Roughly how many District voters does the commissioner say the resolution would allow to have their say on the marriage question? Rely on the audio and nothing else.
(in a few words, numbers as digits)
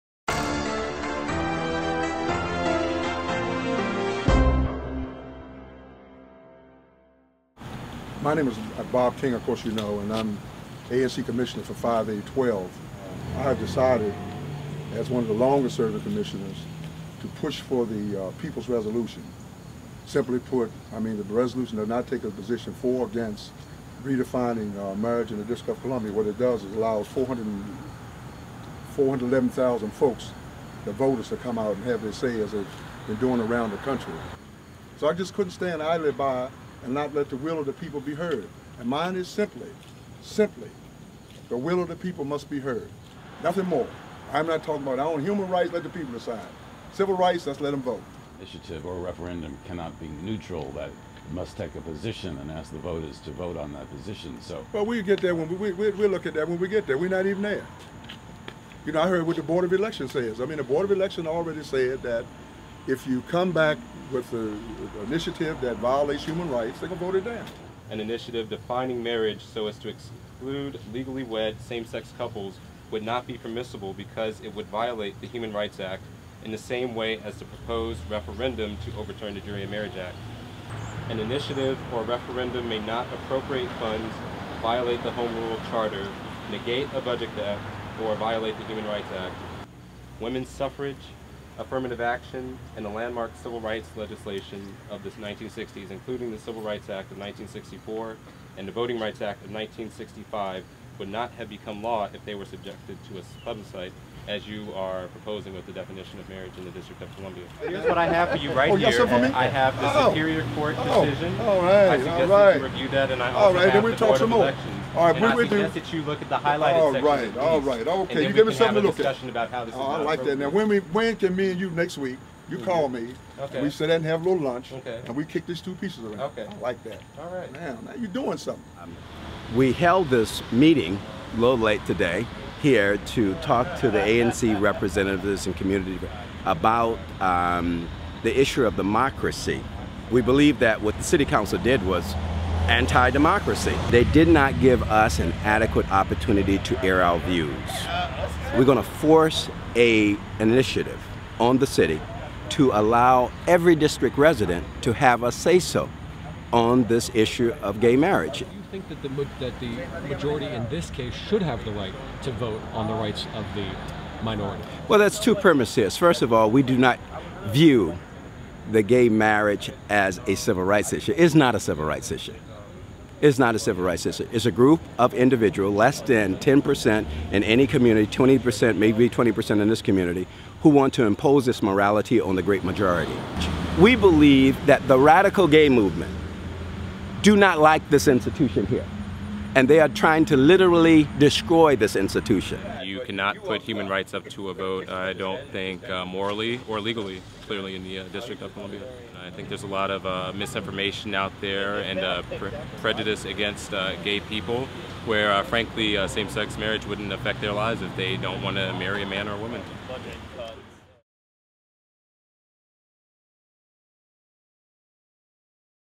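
411,000.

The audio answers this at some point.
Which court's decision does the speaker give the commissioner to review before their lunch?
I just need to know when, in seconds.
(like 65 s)
110 s.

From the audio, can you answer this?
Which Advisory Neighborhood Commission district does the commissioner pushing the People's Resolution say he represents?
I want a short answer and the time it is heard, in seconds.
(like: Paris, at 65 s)
5A12, at 11 s.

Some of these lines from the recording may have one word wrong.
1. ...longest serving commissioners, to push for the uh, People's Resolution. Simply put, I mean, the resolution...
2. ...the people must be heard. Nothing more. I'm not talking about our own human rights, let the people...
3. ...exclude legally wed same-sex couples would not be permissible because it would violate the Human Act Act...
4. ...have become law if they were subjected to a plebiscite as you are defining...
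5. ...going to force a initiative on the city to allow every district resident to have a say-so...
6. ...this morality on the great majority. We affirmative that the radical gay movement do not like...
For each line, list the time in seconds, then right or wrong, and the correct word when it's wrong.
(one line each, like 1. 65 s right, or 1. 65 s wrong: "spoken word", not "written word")
1. 15 s right
2. 41 s right
3. 69 s wrong: "Rights", not "Act"
4. 101 s wrong: "proposing", not "defining"
5. 148 s right
6. 181 s wrong: "believe", not "affirmative".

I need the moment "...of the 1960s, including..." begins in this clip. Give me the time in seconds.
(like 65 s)
94 s.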